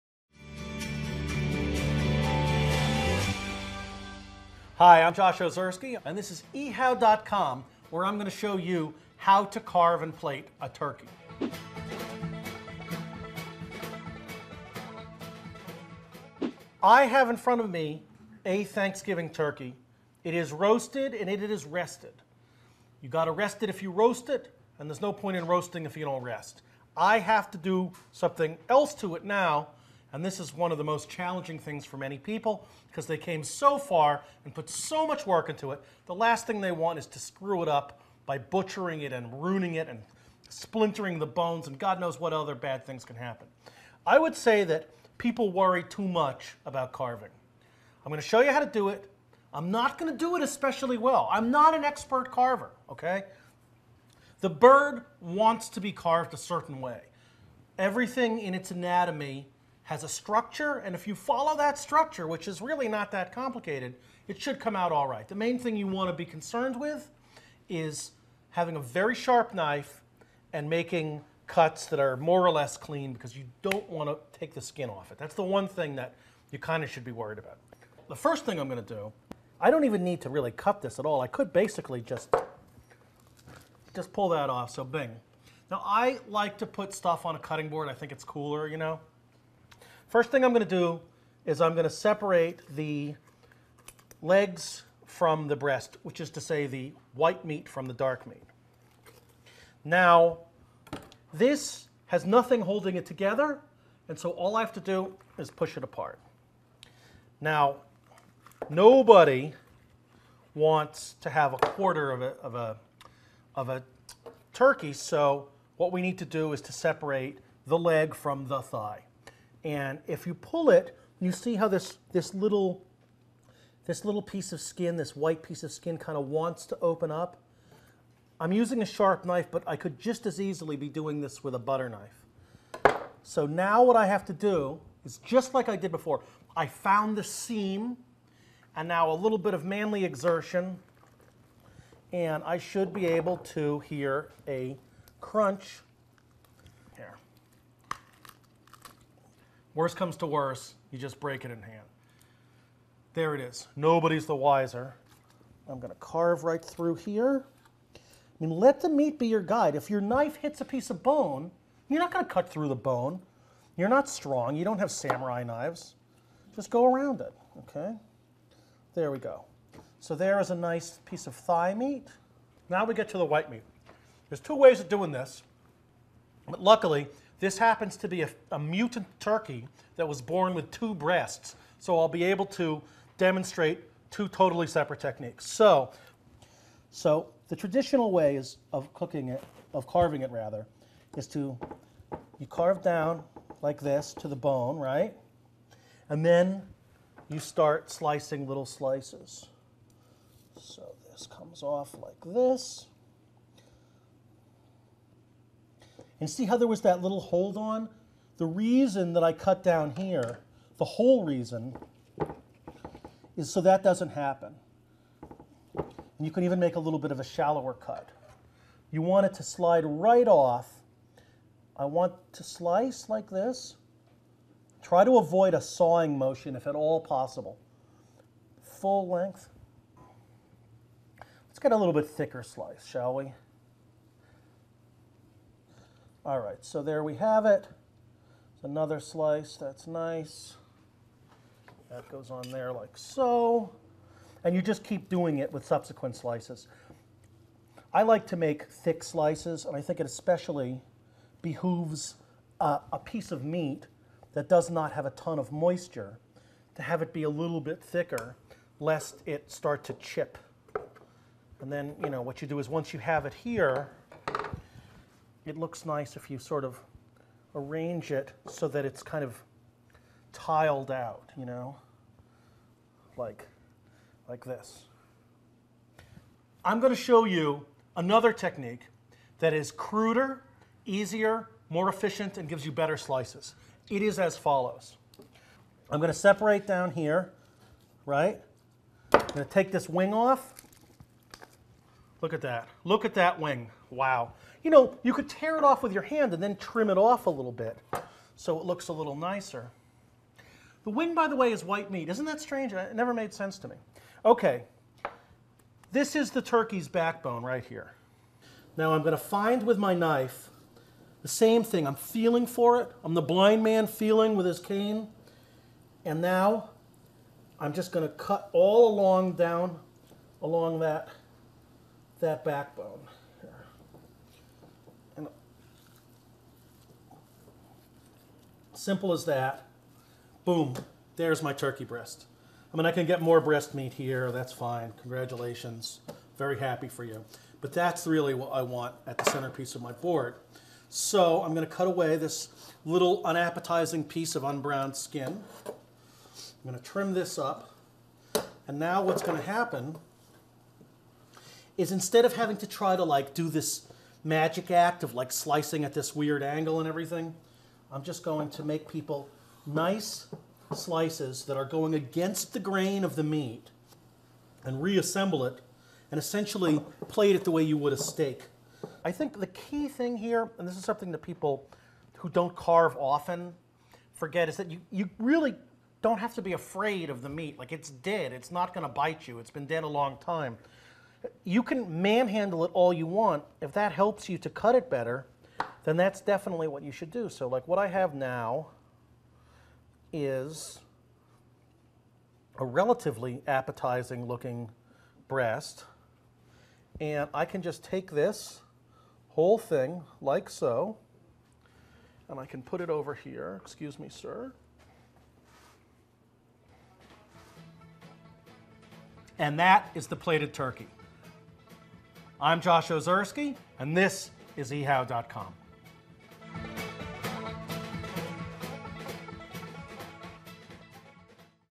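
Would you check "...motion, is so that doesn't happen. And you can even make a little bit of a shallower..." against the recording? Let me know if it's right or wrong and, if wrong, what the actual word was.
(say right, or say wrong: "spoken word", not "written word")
wrong: "reason", not "motion".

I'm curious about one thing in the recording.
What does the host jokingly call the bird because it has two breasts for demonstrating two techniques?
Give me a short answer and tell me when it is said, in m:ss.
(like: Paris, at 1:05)
A mutant turkey, at 2:58.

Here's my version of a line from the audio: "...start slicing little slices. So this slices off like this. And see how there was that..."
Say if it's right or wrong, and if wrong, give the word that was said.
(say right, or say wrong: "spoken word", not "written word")
wrong: "comes", not "slices".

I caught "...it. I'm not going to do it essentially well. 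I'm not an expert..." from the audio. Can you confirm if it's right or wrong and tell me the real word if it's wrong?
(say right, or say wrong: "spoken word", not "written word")
wrong: "especially", not "essentially".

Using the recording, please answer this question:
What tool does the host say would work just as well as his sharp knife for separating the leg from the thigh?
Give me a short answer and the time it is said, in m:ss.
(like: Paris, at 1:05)
Butter knife, at 2:11.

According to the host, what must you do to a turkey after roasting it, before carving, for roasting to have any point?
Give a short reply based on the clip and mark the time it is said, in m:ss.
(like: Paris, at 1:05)
Rest it, at 0:23.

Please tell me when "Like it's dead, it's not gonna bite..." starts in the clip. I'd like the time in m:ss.
6:17.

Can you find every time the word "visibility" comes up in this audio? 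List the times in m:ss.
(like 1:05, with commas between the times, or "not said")
not said.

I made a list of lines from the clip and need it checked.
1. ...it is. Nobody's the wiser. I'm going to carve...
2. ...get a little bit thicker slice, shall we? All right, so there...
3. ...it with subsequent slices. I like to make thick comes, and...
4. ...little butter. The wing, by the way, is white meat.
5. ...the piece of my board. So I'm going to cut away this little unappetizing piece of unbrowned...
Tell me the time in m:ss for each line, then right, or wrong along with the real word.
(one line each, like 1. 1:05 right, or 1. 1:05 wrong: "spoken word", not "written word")
1. 2:33 right
2. 3:51 right
3. 4:05 wrong: "slices", not "comes"
4. 4:58 wrong: "nicer", not "butter"
5. 5:39 wrong: "centerpiece", not "piece".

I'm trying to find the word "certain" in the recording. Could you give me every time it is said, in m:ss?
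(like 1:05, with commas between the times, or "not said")
0:56.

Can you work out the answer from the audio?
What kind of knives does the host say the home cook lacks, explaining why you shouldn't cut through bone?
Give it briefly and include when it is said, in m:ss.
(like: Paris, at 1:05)
Samurai knives, at 2:44.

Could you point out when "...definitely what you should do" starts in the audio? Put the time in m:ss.
6:26.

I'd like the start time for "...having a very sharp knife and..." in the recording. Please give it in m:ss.
1:08.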